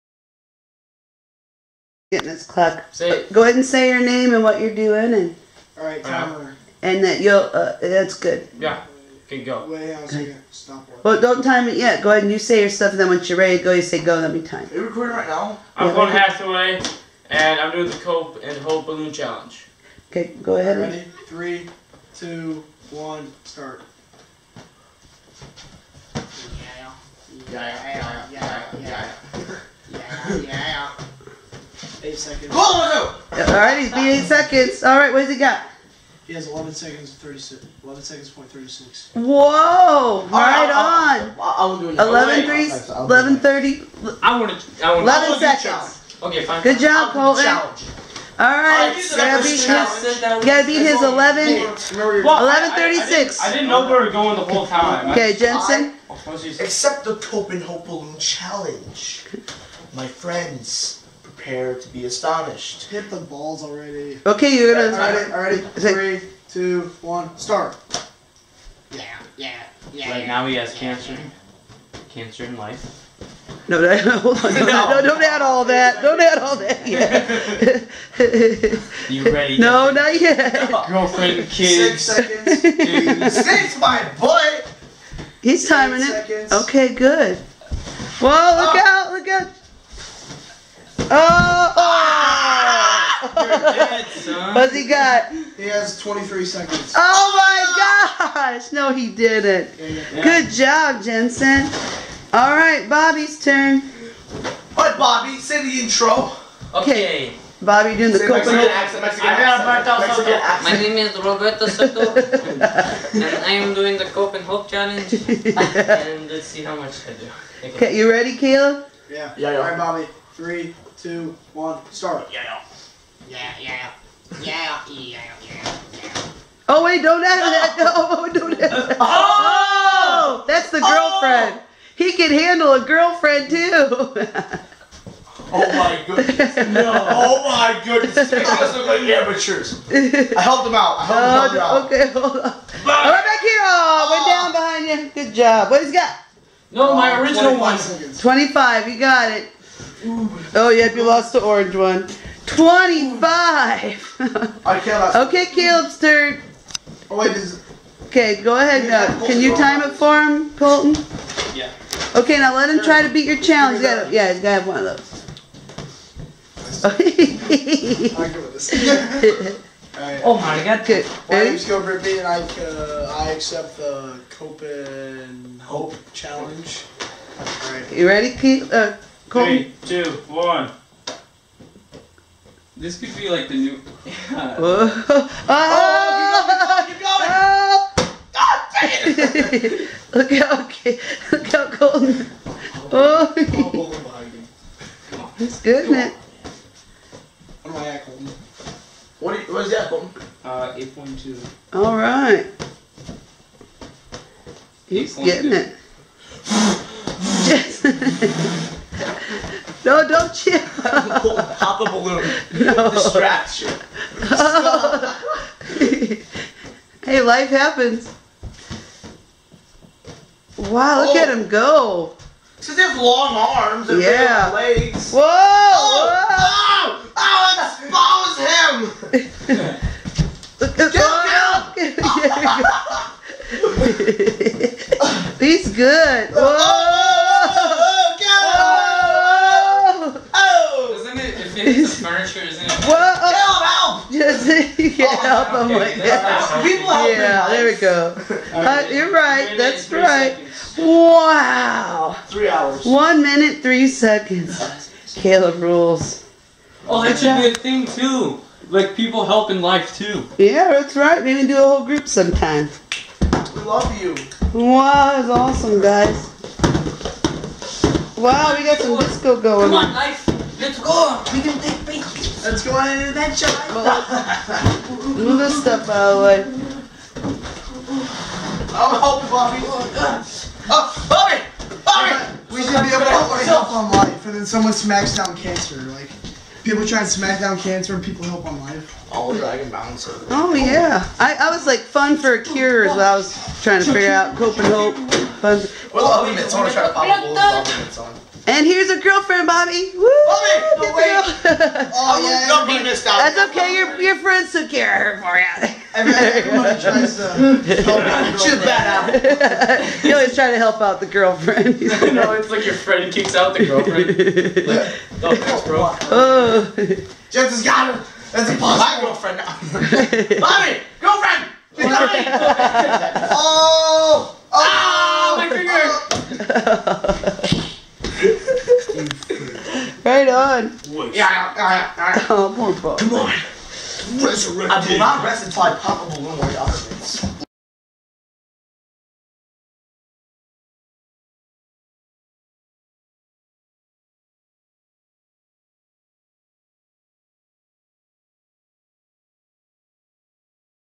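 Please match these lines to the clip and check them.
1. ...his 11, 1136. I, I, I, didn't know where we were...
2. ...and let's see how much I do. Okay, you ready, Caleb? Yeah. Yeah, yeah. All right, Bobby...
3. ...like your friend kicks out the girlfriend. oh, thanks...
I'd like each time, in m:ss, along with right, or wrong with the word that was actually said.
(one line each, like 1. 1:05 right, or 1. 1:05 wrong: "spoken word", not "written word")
1. 0:50 right
2. 1:55 right
3. 5:12 right.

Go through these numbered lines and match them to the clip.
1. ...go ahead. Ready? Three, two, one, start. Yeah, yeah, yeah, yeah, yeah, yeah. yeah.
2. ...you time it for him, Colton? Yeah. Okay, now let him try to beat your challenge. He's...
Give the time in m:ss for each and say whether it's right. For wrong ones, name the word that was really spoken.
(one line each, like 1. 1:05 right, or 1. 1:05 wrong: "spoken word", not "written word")
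1. 0:20 right
2. 2:39 right.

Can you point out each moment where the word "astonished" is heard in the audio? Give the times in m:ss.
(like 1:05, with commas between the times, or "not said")
1:02.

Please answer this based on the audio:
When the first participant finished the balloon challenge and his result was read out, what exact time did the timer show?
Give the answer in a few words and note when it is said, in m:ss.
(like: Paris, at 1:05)
11.36 seconds, at 0:37.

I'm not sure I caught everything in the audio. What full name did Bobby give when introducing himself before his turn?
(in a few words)
Roberto Soto.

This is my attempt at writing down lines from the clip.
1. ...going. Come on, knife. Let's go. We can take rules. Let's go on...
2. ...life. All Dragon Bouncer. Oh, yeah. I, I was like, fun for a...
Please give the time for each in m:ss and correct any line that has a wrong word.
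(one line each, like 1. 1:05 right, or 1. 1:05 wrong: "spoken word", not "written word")
1. 4:29 wrong: "pictures", not "rules"
2. 4:48 right.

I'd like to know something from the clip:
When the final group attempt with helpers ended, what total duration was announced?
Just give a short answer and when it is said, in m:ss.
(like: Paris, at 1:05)
1 minute 3 seconds, at 4:12.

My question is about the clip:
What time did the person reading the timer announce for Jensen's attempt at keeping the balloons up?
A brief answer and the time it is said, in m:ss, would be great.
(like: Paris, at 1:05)
23 seconds, at 1:35.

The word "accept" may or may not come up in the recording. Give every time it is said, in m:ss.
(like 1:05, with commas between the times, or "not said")
0:56, 2:53.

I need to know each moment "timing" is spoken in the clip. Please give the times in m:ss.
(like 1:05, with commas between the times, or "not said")
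1:25.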